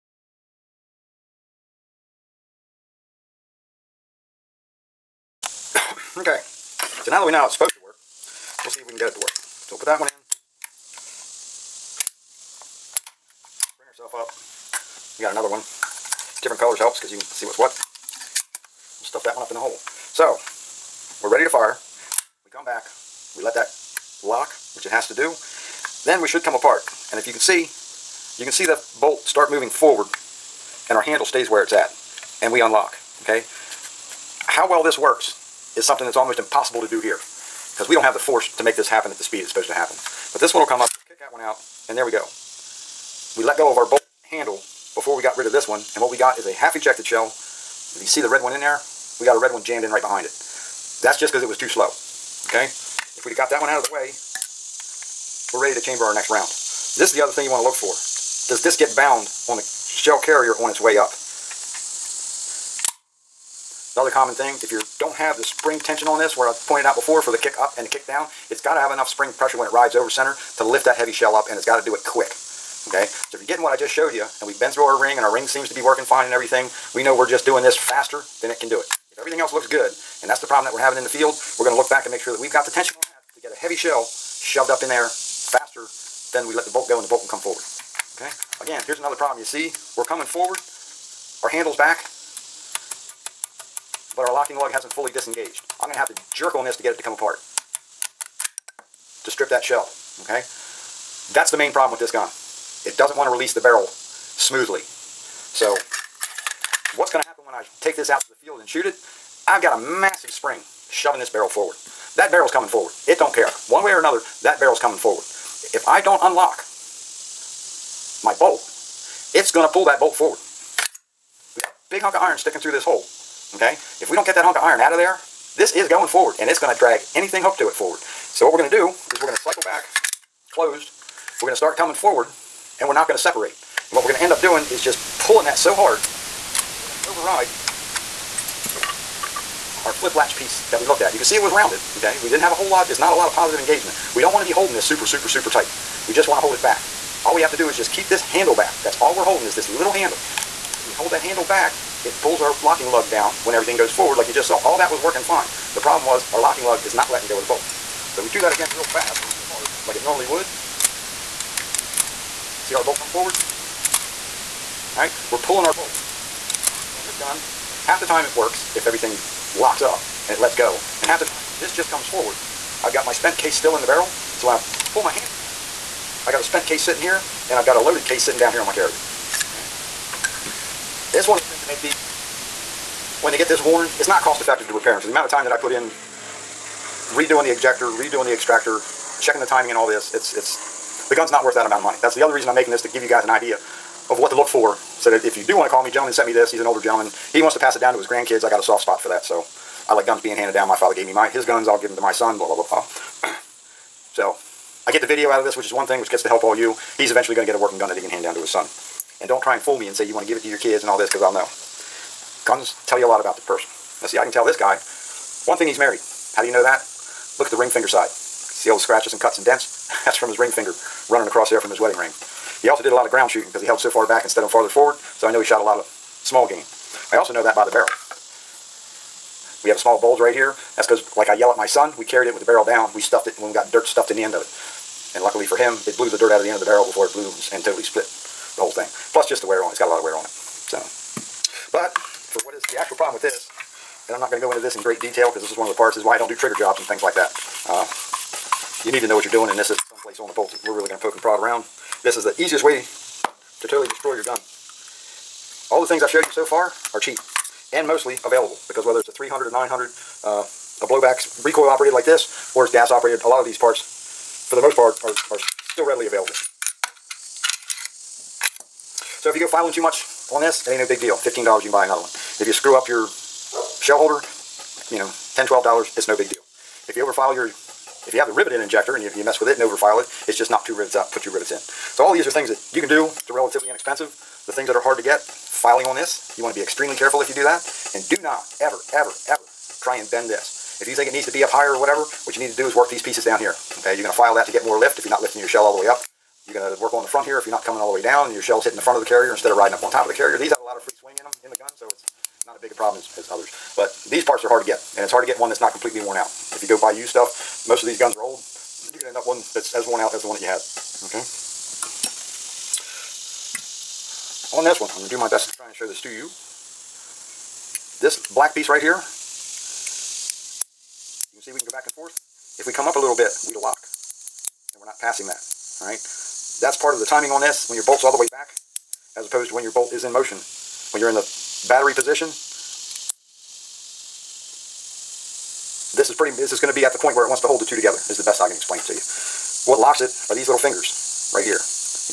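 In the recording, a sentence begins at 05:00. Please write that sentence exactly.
These have a lot of free swing in them, in the gun, so it's not as big a problem as, as others.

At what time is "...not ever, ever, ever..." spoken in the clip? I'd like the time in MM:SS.
04:48.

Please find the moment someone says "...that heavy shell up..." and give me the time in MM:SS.
01:10.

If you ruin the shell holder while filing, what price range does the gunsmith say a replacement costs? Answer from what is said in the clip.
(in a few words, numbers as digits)
$10 to $12.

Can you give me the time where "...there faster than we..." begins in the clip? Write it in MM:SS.
01:24.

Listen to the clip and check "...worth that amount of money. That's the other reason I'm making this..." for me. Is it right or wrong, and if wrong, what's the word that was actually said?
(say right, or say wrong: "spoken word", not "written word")
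right.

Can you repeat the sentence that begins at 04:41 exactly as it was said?
So all these are things that you can do.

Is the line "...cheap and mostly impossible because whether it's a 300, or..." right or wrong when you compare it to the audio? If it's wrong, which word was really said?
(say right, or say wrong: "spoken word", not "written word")
wrong: "available", not "impossible".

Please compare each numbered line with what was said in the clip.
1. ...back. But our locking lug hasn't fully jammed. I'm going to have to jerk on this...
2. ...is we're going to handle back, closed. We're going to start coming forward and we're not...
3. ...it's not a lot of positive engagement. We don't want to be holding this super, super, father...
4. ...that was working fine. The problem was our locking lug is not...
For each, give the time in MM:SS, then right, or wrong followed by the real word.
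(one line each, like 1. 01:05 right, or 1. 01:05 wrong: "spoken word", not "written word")
1. 01:31 wrong: "disengaged", not "jammed"
2. 02:08 wrong: "cycle", not "handle"
3. 02:22 wrong: "super", not "father"
4. 02:34 right.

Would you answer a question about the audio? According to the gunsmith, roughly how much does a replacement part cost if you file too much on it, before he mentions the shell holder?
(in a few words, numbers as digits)
$15.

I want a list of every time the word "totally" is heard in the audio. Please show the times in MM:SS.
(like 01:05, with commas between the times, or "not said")
03:57, 04:13.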